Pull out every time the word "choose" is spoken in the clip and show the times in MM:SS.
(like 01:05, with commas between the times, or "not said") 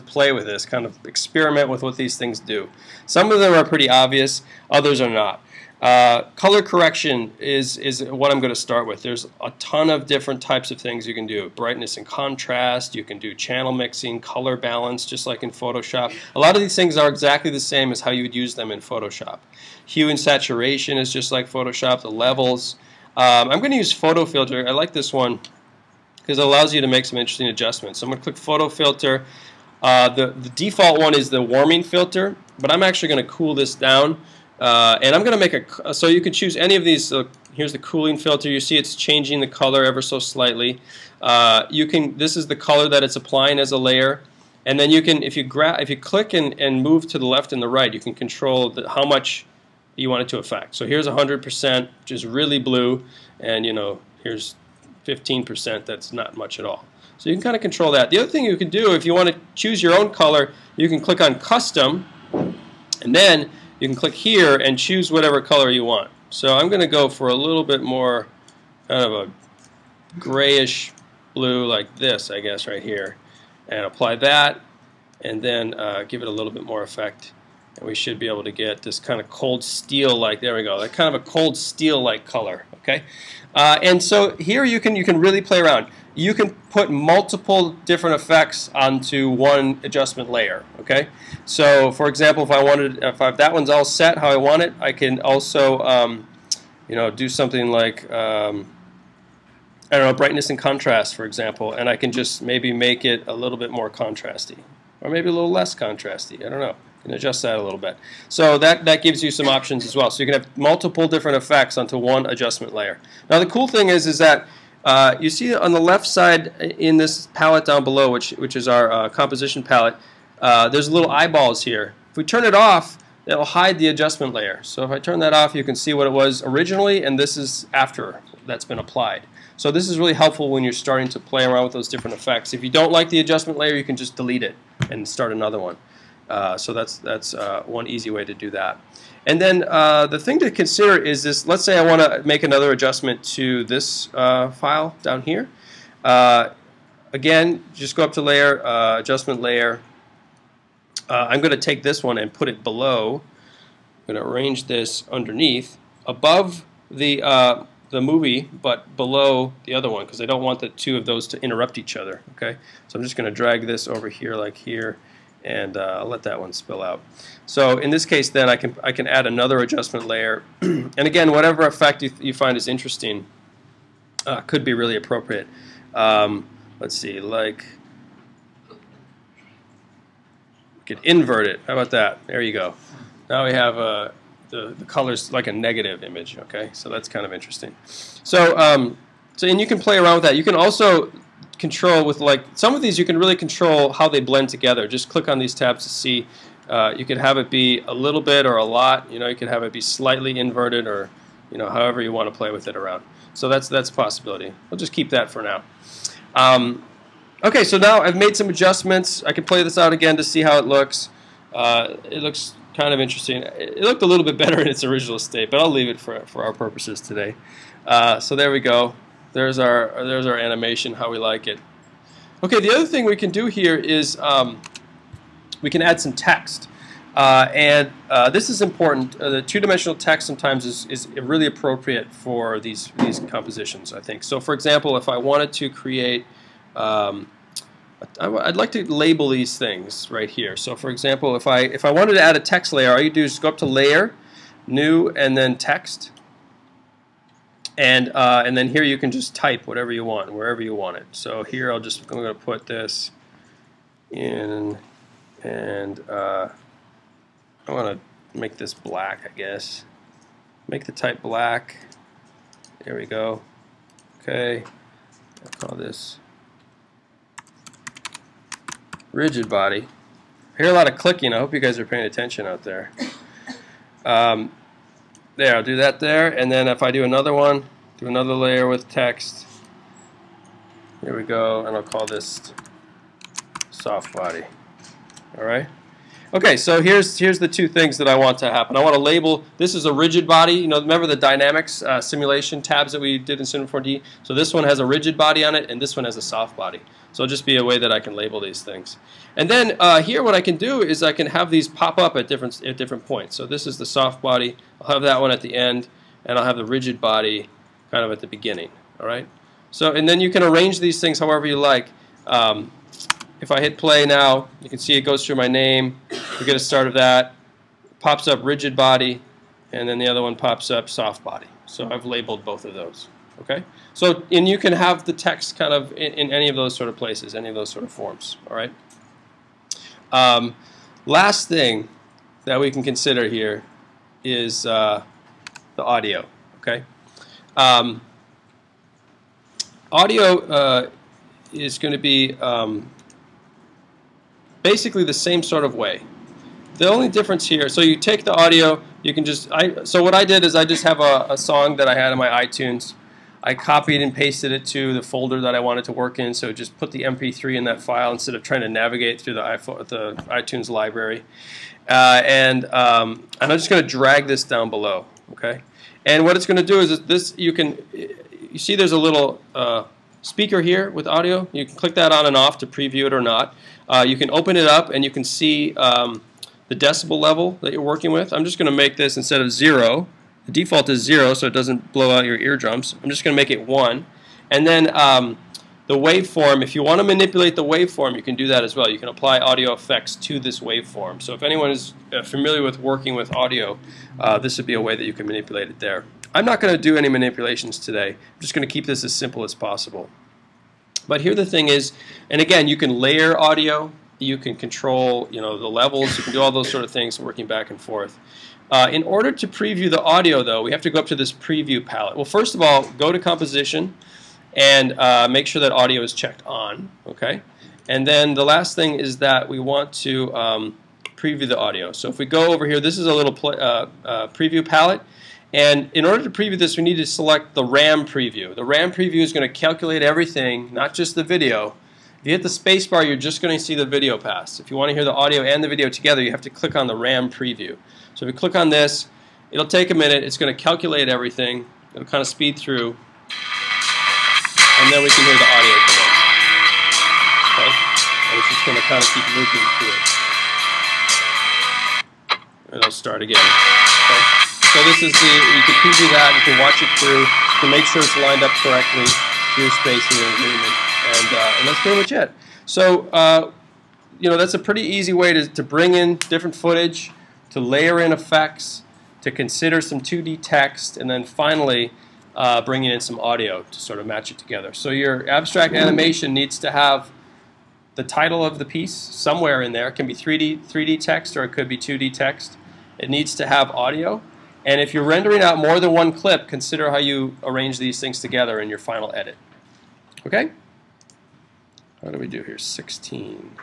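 00:36, 00:59, 01:04.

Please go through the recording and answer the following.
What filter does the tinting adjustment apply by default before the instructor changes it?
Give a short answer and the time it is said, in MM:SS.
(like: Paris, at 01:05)
warming filter, at 00:31.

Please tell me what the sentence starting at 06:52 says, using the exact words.
Well, first of all, go to composition and uh, make sure that audio is checked on.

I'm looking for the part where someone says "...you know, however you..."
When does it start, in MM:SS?
03:21.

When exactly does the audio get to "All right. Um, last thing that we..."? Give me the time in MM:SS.
05:28.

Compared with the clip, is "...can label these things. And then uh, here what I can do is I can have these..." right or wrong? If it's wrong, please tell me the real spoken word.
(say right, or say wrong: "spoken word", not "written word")
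right.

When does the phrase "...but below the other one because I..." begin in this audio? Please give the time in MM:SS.
02:38.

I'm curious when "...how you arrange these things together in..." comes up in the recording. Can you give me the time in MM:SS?
08:06.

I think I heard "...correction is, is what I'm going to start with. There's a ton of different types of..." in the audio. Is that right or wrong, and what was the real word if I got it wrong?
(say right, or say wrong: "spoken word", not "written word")
right.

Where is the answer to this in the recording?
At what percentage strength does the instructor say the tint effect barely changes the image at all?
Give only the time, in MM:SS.
00:55.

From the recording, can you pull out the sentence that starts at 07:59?
It can be 3D, 3D text or it could be 2D text.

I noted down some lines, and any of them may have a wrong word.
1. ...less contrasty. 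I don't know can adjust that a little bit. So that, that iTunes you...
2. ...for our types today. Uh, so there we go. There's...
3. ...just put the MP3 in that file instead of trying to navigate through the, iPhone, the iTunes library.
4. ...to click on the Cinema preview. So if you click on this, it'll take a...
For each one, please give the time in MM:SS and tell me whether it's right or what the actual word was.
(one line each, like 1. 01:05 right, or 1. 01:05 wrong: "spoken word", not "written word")
1. 01:45 wrong: "gives", not "iTunes"
2. 03:36 wrong: "purposes", not "types"
3. 05:56 right
4. 07:16 wrong: "RAM", not "Cinema".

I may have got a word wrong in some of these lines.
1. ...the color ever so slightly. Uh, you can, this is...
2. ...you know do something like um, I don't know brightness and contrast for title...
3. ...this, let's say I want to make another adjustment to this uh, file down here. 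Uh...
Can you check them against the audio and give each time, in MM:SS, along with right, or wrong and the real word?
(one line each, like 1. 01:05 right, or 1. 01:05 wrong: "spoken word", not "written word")
1. 00:39 right
2. 01:36 wrong: "example", not "title"
3. 02:21 right.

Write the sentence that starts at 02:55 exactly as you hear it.
Um, let's see, like we could invert it.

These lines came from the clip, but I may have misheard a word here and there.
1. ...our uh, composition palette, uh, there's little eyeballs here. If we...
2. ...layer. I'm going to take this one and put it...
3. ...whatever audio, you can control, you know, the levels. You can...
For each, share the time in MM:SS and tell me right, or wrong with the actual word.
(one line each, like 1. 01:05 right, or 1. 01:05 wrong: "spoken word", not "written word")
1. 01:58 right
2. 02:29 right
3. 06:42 wrong: "layer", not "whatever".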